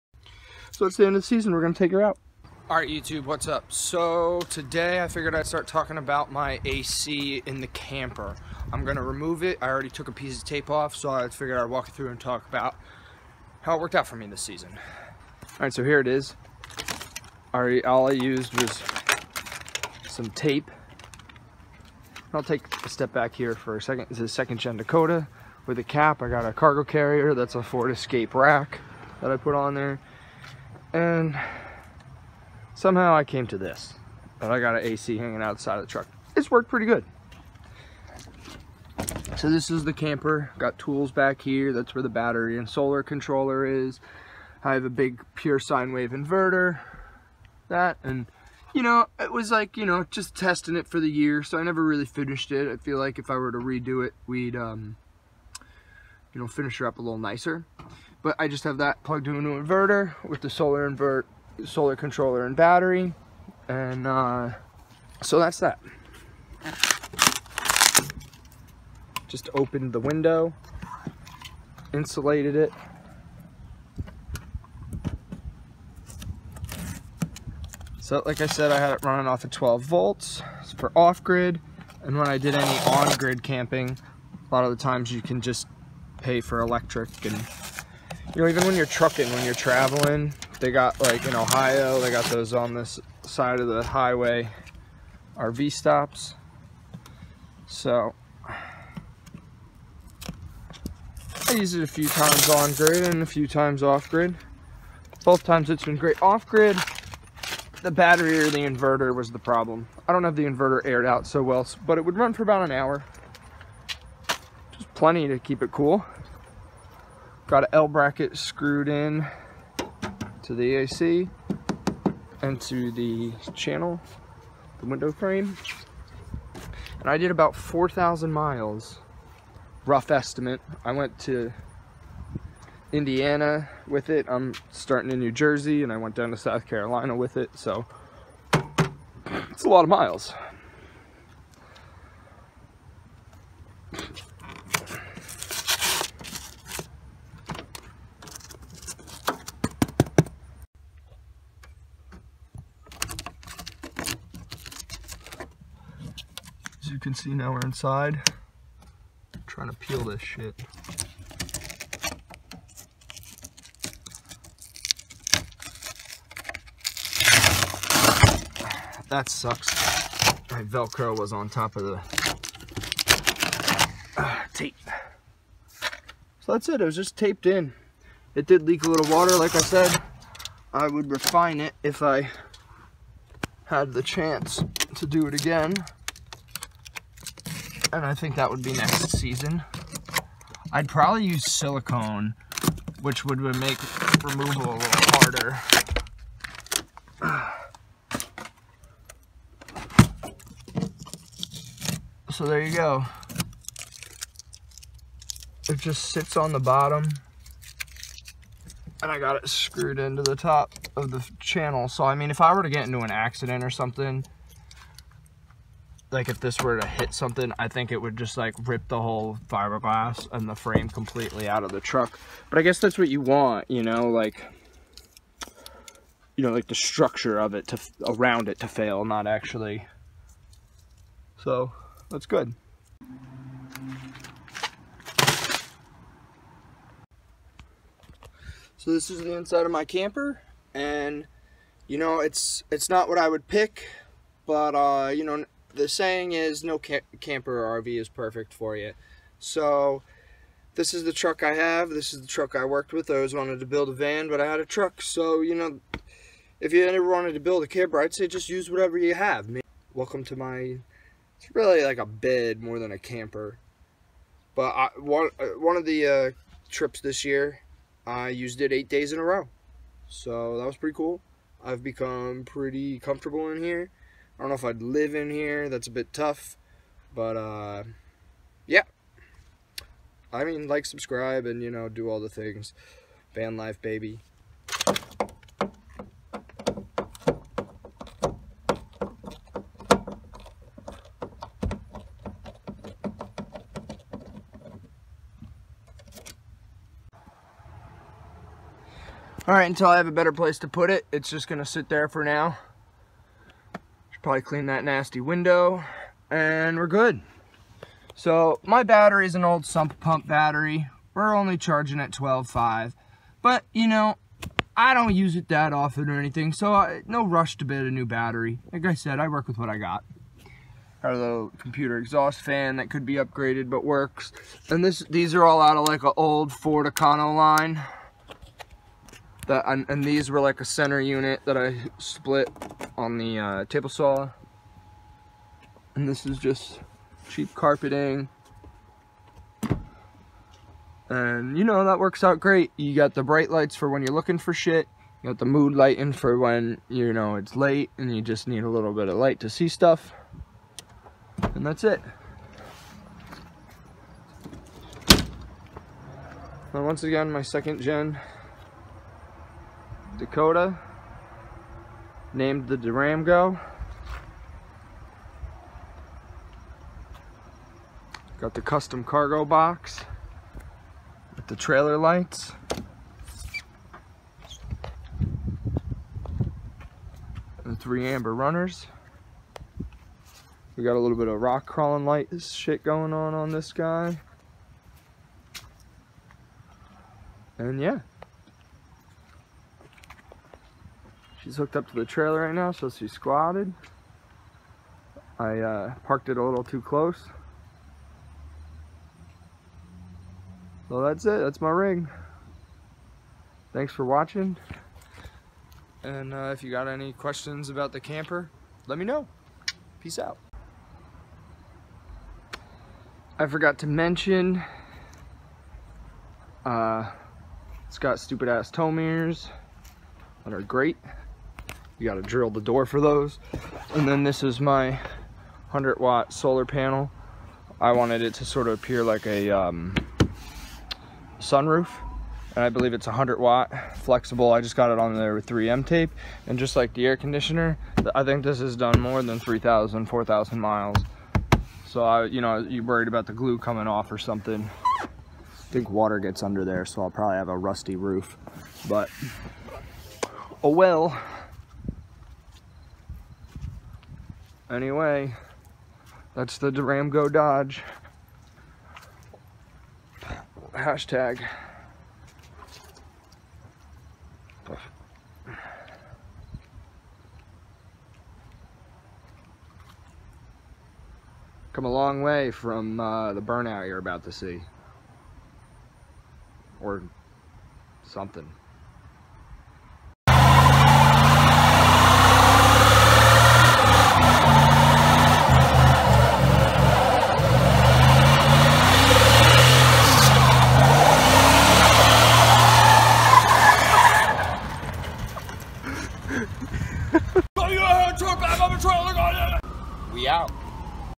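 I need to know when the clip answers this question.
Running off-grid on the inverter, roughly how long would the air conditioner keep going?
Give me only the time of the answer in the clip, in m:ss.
1:52.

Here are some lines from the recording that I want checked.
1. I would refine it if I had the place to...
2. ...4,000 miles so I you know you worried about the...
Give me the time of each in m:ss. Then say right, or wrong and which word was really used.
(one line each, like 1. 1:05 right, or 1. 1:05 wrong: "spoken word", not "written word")
1. 3:00 wrong: "chance", not "place"
2. 7:20 right.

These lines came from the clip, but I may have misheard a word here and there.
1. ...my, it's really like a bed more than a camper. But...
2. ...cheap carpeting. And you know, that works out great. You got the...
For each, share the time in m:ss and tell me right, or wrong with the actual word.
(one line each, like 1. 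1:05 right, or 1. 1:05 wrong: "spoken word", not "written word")
1. 4:20 right
2. 5:37 right.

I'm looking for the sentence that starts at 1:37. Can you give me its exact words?
So I use it a few times on grid and a few times off grid.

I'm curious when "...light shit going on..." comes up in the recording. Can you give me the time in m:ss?
6:22.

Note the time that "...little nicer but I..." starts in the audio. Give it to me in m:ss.
0:57.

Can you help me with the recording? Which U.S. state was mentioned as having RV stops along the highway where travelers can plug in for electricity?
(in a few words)
Ohio.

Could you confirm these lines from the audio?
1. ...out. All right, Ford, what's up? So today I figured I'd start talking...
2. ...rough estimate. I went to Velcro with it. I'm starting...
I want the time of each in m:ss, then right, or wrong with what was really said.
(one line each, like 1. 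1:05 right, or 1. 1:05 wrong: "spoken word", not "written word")
1. 0:02 wrong: "YouTube", not "Ford"
2. 2:09 wrong: "Indiana", not "Velcro".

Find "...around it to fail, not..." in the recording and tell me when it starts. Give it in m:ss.
3:48.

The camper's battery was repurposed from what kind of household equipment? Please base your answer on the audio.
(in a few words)
sump pump.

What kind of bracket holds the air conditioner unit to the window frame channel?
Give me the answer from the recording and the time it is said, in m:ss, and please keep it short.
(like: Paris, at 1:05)
L bracket, at 1:57.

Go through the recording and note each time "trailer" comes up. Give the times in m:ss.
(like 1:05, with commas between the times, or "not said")
6:11, 6:32.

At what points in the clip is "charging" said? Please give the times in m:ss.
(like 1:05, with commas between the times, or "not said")
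5:11.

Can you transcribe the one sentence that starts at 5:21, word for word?
Our little computer exhaust fan that could be upgraded but works.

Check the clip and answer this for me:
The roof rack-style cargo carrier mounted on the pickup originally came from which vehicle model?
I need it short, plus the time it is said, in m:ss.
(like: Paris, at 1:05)
Ford Escape, at 0:27.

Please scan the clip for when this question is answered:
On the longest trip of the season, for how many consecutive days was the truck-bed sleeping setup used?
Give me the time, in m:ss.
4:28.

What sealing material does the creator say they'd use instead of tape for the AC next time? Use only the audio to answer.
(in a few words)
silicone.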